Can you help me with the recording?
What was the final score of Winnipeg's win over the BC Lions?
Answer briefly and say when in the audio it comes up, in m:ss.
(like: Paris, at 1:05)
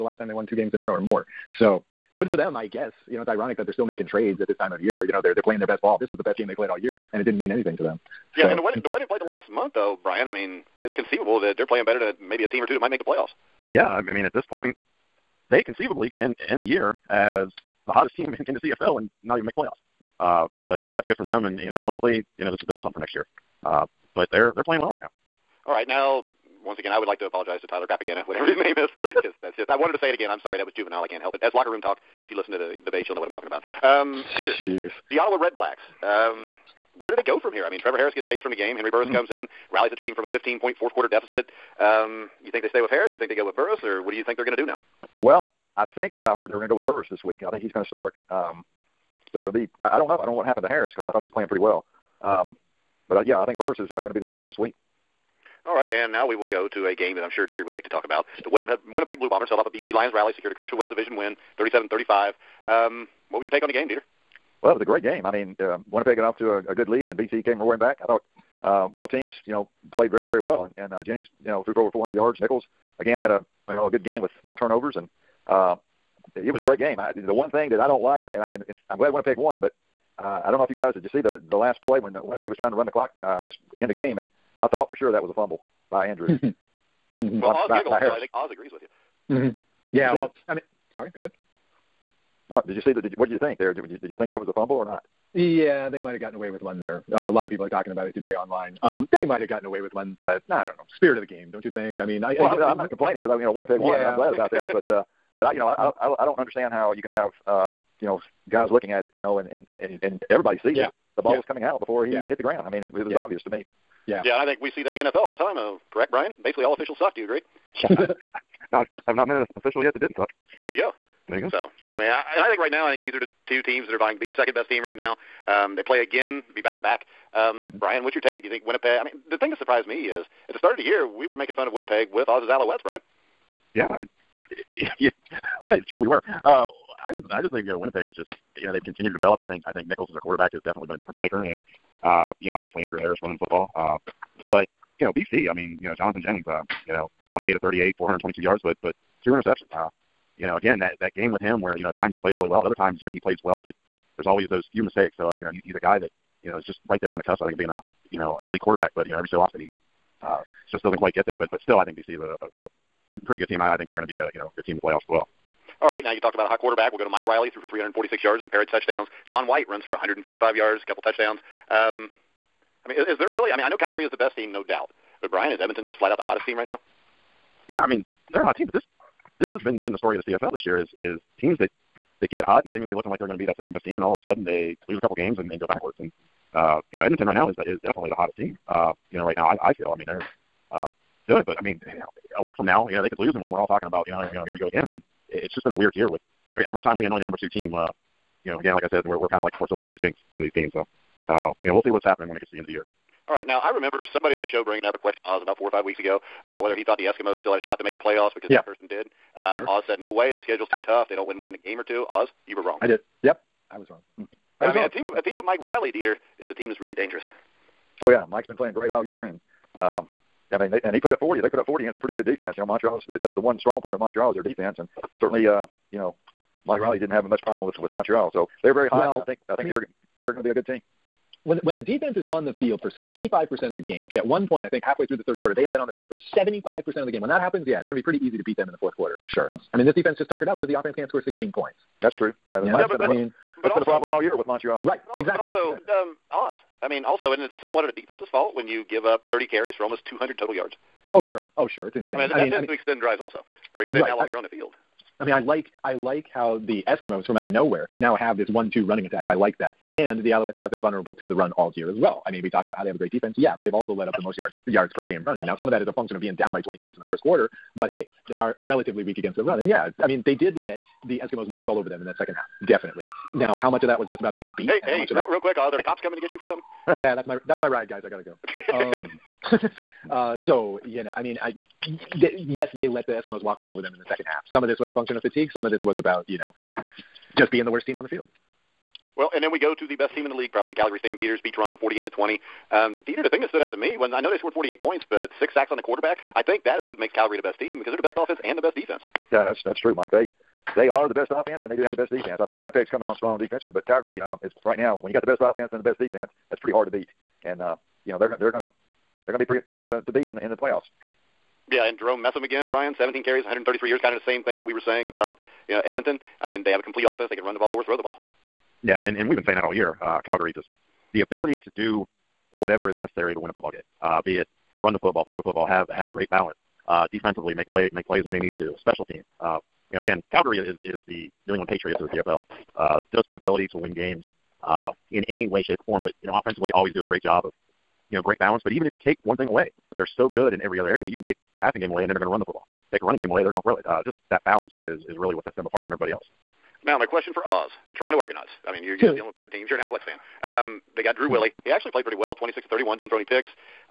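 37-35, at 1:01.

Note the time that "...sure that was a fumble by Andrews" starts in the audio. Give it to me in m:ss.
1:24.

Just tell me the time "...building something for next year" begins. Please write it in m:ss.
0:22.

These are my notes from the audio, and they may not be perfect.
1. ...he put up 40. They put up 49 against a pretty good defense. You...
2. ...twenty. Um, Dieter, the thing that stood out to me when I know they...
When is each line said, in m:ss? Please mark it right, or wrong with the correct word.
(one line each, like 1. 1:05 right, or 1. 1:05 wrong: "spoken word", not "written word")
1. 3:40 wrong: "40", not "49"
2. 4:52 right.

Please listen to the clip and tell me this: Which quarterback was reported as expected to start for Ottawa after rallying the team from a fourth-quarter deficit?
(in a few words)
Henry Burris.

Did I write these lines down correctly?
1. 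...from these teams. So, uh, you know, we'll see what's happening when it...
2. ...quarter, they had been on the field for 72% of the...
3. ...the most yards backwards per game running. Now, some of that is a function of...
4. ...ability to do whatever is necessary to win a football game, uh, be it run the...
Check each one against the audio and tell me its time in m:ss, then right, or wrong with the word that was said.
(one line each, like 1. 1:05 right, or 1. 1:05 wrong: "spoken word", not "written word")
1. 3:20 right
2. 3:55 wrong: "75", not "72"
3. 4:24 wrong: "yards", not "backwards"
4. 5:21 right.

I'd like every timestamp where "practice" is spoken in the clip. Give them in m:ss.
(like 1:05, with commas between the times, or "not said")
not said.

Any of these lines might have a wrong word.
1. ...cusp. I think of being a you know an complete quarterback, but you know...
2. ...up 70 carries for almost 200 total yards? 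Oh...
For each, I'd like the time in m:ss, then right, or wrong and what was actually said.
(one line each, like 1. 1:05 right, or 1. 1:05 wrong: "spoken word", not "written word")
1. 2:37 wrong: "elite", not "complete"
2. 4:09 wrong: "30", not "70".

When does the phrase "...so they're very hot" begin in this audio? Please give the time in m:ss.
3:48.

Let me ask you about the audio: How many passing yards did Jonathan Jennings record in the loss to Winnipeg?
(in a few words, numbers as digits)
422.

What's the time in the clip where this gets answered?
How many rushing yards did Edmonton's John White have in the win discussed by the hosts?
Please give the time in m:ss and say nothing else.
2:49.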